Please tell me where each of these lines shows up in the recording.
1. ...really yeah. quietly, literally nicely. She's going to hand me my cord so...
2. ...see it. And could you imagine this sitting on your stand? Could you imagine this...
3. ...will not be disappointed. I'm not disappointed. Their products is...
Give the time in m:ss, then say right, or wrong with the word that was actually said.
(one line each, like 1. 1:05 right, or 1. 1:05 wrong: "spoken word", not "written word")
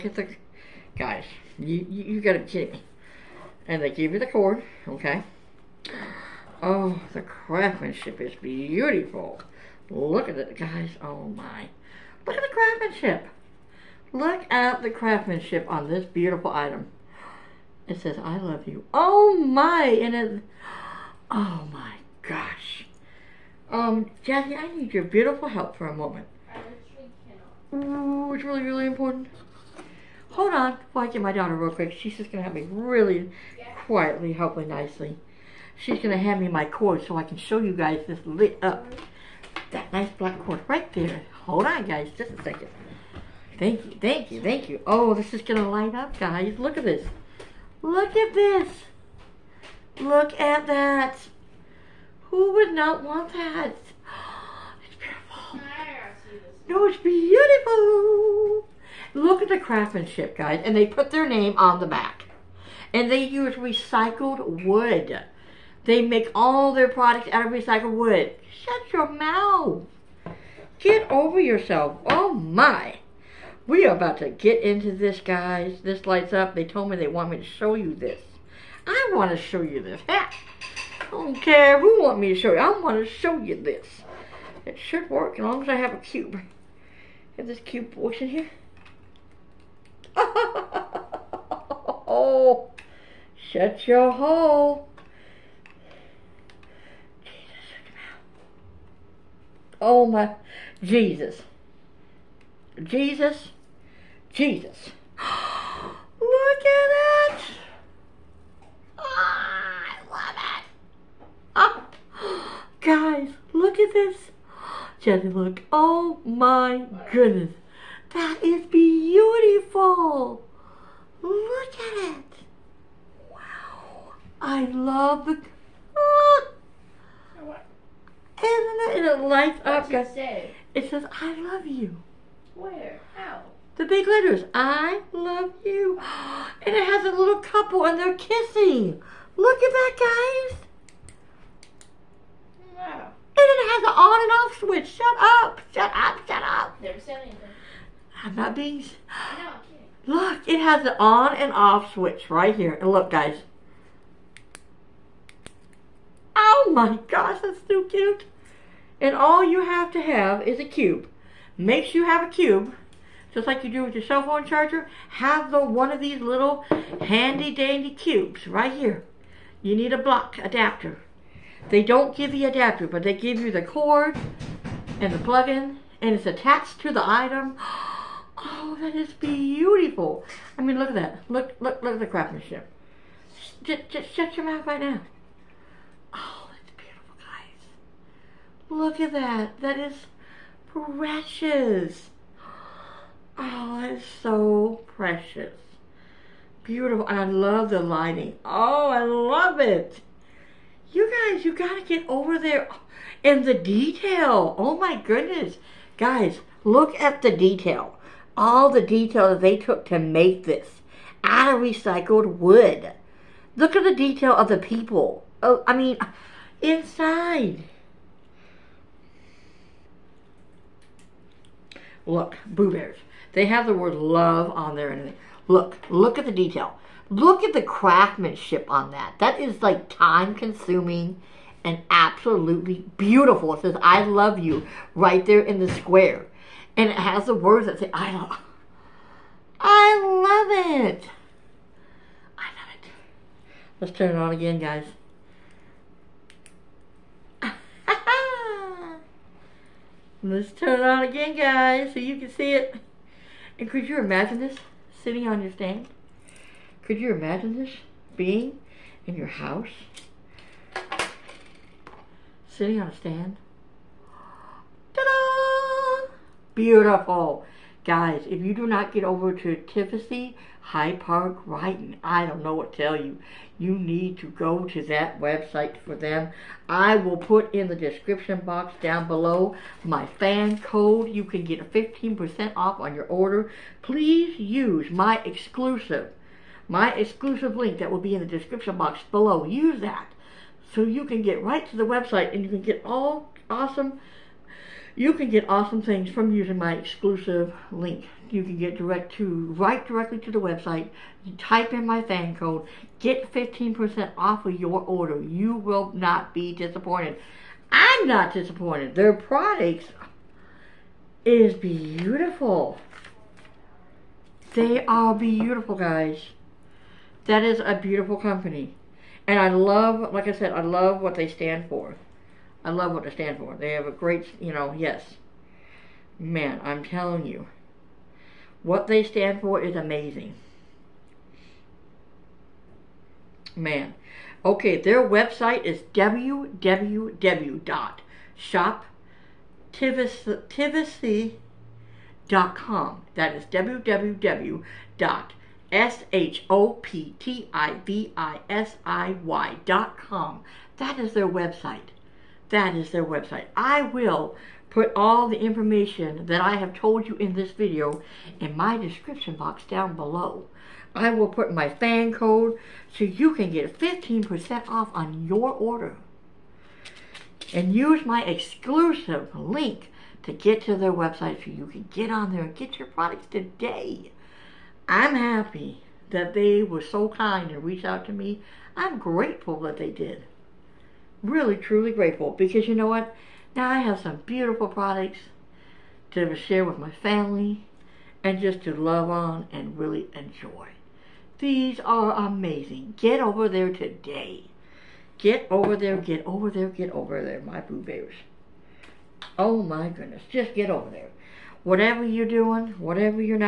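1. 0:32 wrong: "hopefully", not "literally"
2. 4:12 right
3. 5:05 right.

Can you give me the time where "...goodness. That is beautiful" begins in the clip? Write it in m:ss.
1:57.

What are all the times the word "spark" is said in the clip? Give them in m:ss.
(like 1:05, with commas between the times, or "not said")
not said.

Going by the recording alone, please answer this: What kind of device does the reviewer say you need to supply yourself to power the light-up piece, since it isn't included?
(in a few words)
block adapter.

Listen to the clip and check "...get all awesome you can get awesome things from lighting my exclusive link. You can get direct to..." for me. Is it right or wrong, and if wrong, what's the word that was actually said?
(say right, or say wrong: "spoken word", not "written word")
wrong: "using", not "lighting".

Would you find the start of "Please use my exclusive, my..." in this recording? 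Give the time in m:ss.
4:43.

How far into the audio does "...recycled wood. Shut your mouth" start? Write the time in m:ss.
1:07.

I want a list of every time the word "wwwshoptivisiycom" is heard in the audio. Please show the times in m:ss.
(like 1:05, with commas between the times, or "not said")
5:35, 5:43.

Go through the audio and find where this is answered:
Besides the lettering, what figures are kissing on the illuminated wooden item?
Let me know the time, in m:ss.
2:17.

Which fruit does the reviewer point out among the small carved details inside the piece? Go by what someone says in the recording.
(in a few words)
blueberries.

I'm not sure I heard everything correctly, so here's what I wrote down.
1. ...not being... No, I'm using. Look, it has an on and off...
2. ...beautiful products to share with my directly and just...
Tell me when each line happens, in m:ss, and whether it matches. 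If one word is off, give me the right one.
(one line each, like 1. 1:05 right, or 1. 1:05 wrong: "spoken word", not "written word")
1. 2:28 wrong: "kidding", not "using"
2. 6:24 wrong: "family", not "directly".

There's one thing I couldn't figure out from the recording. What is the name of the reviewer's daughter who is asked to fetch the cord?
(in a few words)
Jackie.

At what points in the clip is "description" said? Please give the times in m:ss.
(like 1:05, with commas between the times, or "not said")
4:37, 4:48, 5:58.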